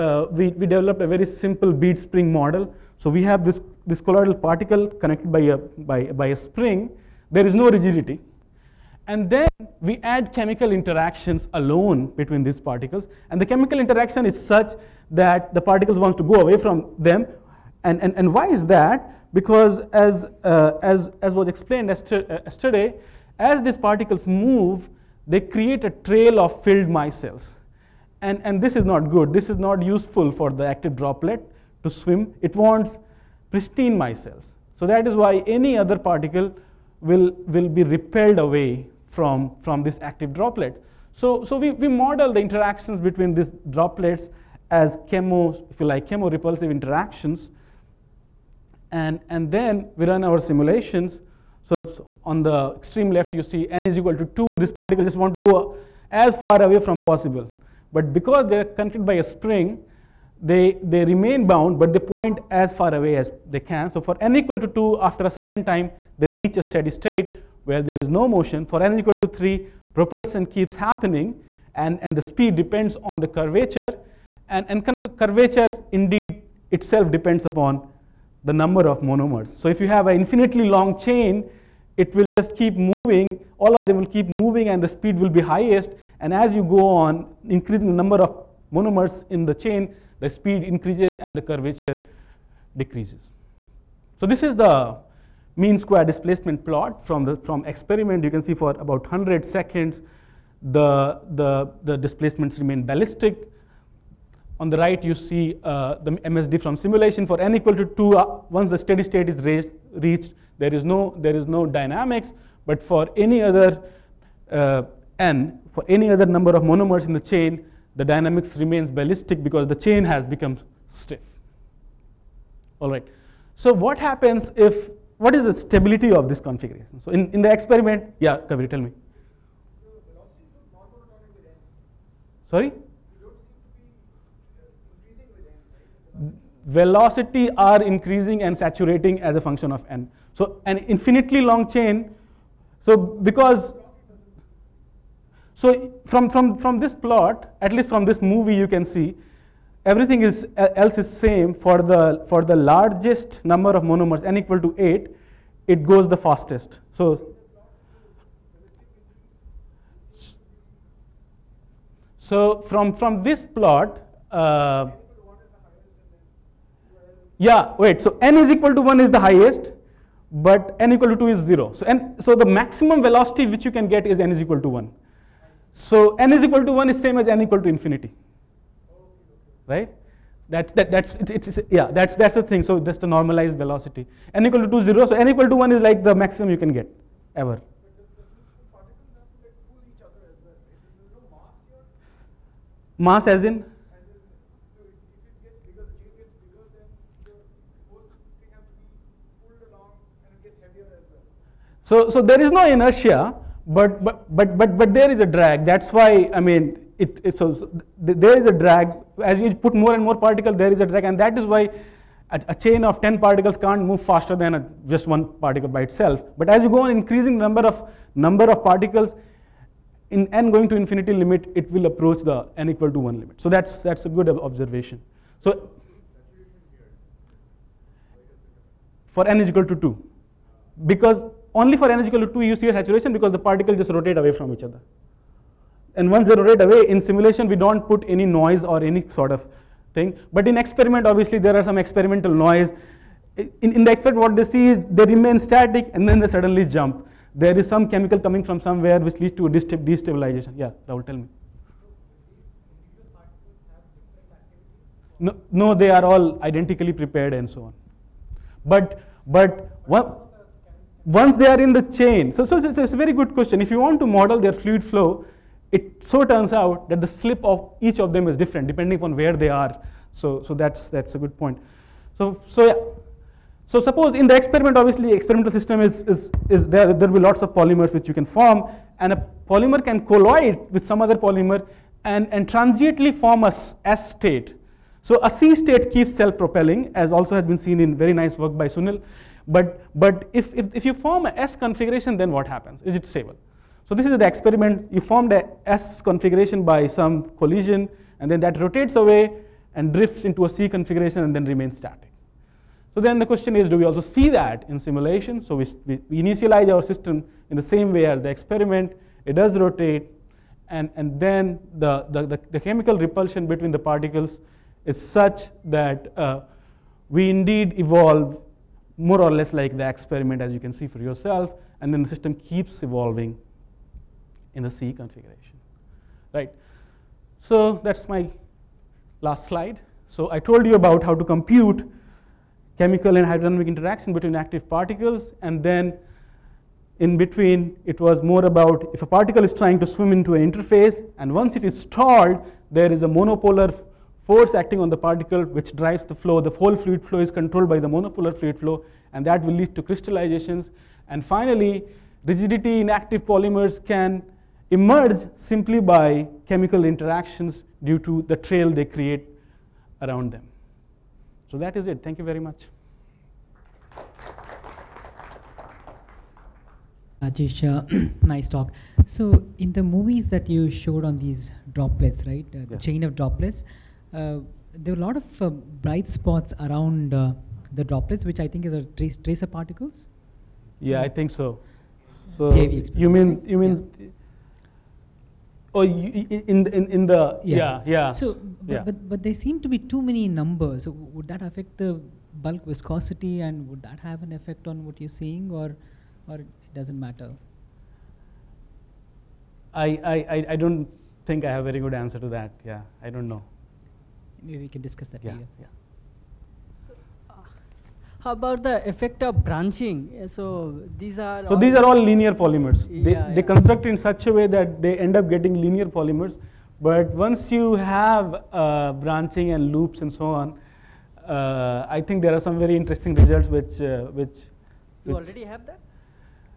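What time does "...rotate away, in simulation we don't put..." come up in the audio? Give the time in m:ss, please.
3:56.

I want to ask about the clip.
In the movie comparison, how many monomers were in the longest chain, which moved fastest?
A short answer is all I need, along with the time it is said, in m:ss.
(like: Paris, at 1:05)
8, at 2:34.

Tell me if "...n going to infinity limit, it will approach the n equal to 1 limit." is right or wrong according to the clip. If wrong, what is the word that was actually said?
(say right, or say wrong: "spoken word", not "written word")
right.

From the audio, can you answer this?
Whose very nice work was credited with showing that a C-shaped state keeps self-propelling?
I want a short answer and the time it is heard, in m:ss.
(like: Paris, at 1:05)
Sunil, at 4:48.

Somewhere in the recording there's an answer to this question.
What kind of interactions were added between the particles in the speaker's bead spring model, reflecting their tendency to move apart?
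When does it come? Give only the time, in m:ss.
0:46.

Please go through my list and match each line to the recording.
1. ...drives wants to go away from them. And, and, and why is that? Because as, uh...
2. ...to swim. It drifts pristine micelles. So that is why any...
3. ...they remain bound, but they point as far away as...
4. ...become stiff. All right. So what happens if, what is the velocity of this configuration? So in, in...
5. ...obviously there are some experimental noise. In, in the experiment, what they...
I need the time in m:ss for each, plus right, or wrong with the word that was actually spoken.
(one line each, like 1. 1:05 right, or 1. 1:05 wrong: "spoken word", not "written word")
1. 0:15 wrong: "particles", not "drives"
2. 0:31 wrong: "wants", not "drifts"
3. 1:00 right
4. 2:00 wrong: "stability", not "velocity"
5. 4:01 right.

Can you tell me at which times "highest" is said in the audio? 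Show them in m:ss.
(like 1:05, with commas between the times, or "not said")
1:25, 2:49.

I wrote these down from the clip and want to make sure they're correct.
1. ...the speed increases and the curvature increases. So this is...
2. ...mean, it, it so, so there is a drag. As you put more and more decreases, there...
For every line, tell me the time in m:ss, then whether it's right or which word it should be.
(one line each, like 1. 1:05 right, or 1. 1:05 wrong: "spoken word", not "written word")
1. 1:30 wrong: "decreases", not "increases"
2. 3:26 wrong: "particles", not "decreases".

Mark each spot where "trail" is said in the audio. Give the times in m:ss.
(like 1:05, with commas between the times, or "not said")
0:25, 5:58.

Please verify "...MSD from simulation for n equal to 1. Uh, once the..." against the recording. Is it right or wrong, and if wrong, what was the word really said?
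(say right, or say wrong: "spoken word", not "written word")
wrong: "2", not "1".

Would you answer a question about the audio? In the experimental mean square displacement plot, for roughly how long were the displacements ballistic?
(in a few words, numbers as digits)
100 seconds.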